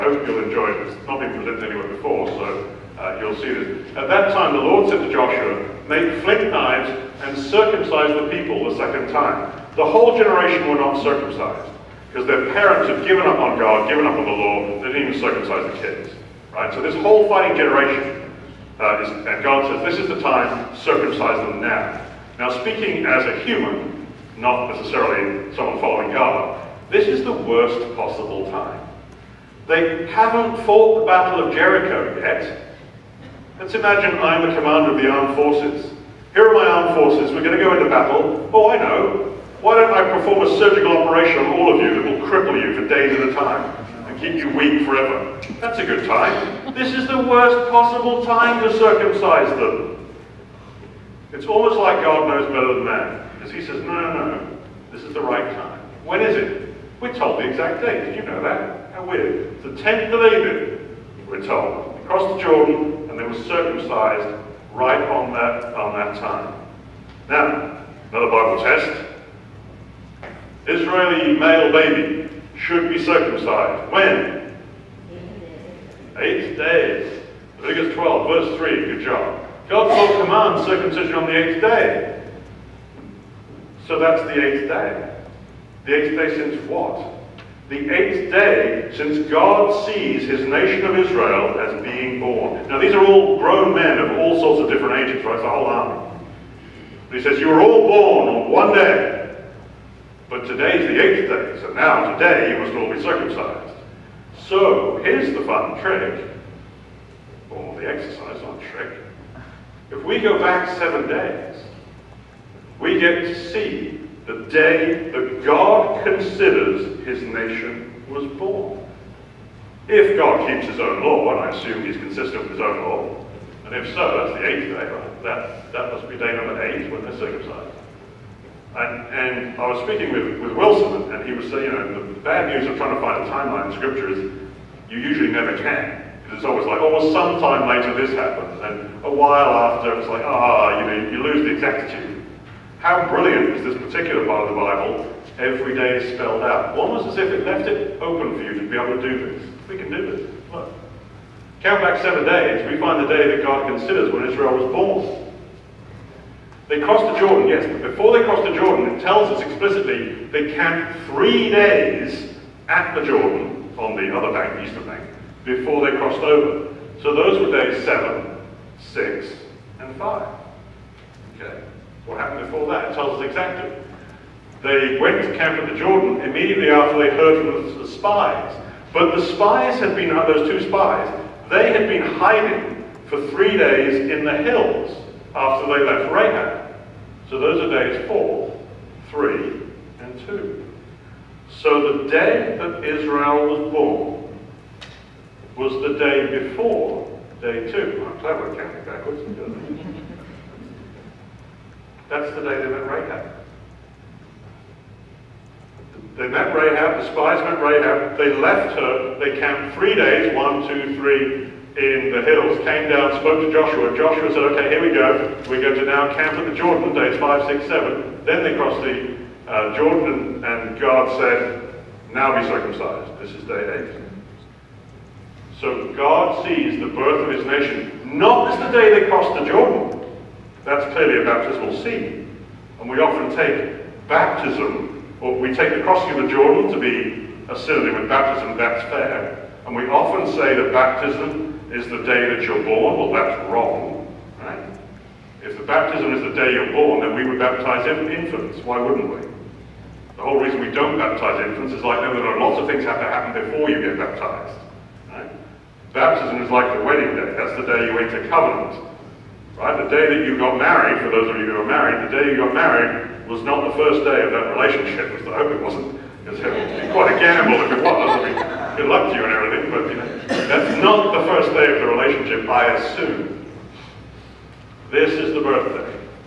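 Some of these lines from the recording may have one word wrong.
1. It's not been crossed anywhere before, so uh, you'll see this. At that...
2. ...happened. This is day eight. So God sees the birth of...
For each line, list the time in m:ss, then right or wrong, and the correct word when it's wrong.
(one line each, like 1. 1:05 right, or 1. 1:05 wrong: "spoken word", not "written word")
1. 0:00 wrong: "presented", not "crossed"
2. 3:42 wrong: "circumcised", not "happened".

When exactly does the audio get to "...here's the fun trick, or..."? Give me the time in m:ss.
1:45.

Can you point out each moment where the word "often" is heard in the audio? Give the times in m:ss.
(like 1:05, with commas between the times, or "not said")
3:52, 3:59.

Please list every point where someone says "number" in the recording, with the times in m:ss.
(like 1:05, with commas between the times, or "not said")
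2:06.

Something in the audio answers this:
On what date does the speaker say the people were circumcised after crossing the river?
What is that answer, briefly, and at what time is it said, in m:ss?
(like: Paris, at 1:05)
10th of Abib, at 0:59.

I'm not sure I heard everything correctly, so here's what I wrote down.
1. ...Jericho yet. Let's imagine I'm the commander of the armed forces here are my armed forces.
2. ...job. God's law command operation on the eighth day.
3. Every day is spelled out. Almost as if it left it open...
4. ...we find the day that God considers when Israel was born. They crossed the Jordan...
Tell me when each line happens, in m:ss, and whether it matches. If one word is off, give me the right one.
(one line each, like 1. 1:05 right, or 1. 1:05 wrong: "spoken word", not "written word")
1. 0:31 right
2. 1:19 wrong: "circumcision", not "operation"
3. 2:25 right
4. 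2:32 right.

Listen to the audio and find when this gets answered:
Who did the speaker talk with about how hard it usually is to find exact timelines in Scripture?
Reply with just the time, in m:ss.
2:10.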